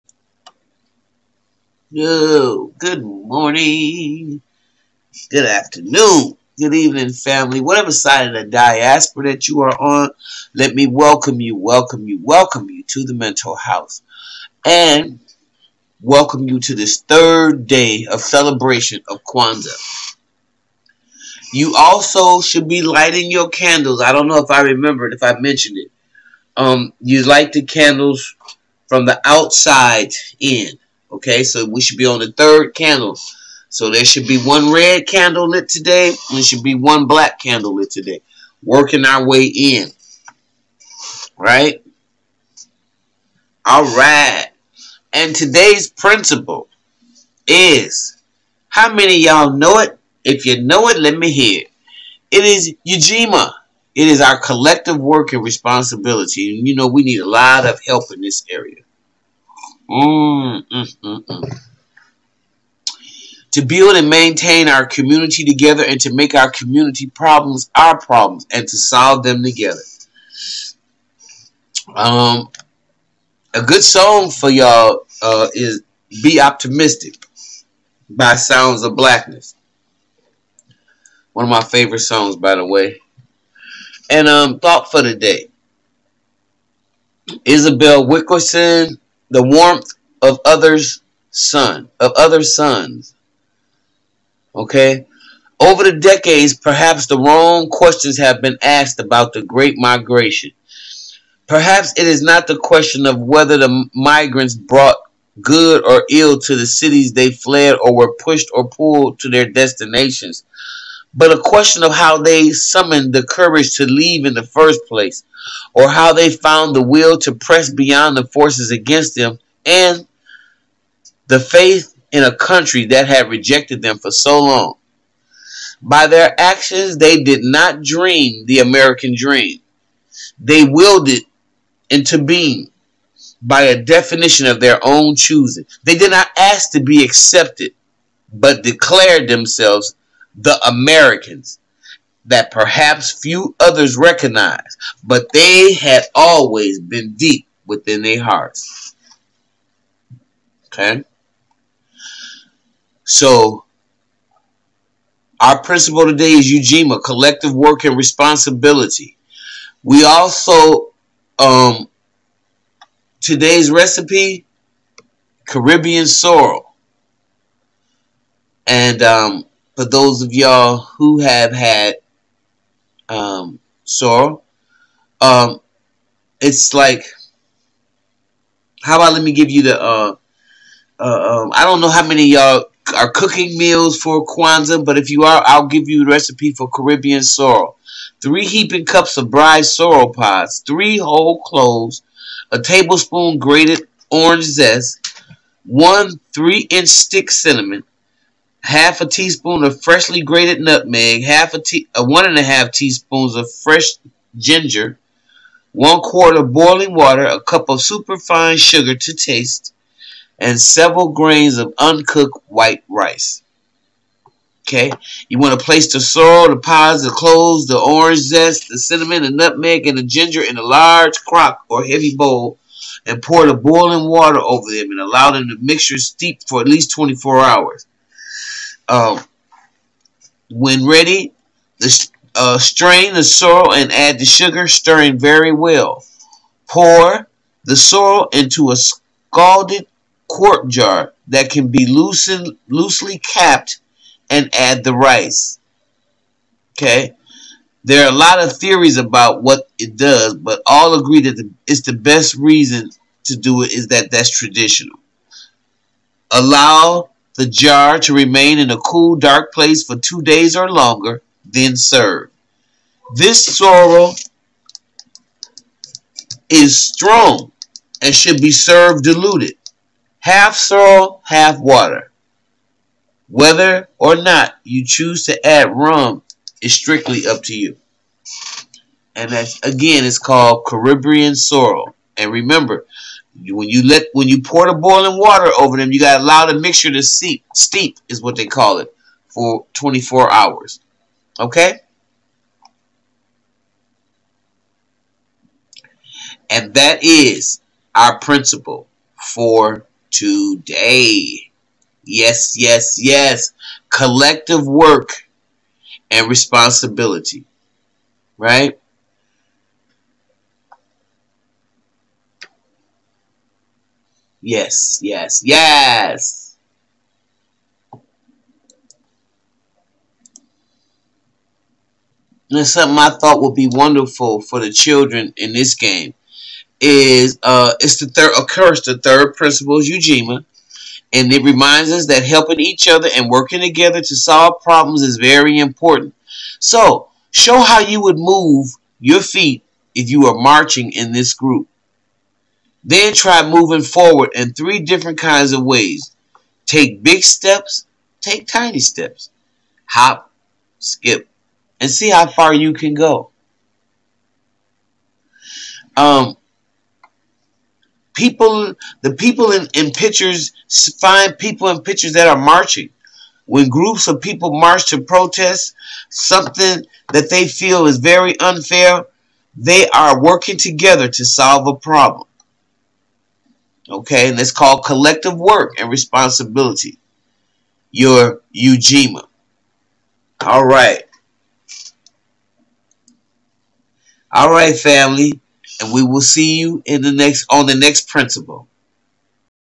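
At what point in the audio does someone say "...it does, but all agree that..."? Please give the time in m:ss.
4:09.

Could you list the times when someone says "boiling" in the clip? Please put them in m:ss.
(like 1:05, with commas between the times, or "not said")
3:26, 3:43, 4:44.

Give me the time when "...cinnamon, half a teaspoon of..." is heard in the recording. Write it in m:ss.
3:17.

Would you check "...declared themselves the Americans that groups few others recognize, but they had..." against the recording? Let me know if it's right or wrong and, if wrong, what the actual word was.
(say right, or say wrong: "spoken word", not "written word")
wrong: "perhaps", not "groups".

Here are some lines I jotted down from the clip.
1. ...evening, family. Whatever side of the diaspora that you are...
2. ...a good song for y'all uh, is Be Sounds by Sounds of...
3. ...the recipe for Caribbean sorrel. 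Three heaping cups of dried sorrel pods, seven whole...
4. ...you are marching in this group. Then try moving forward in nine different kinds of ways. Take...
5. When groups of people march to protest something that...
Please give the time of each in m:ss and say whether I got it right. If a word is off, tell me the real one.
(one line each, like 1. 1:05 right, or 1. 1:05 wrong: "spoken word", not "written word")
1. 0:06 right
2. 1:13 wrong: "Optimistic", not "Sounds"
3. 3:06 wrong: "three", not "seven"
4. 5:40 wrong: "three", not "nine"
5. 6:03 right.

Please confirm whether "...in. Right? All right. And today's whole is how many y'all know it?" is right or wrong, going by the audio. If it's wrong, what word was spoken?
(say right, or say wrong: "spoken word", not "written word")
wrong: "principle", not "whole".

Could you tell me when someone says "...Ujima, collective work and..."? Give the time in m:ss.
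2:36.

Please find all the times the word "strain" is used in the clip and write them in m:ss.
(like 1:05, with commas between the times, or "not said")
3:52.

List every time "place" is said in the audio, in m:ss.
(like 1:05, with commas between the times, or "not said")
1:54, 3:35, 4:19.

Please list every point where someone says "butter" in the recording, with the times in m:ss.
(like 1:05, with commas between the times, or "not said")
not said.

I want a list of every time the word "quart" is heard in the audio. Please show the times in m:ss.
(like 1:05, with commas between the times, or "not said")
3:25, 4:00.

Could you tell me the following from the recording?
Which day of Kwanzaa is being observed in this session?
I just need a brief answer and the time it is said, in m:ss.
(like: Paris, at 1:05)
Third day, at 0:17.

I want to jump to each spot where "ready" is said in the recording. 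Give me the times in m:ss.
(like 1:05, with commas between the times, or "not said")
3:50.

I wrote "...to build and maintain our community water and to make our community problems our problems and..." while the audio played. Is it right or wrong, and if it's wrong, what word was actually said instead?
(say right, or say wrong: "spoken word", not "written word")
wrong: "together", not "water".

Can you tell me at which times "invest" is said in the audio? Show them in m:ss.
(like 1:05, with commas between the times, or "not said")
not said.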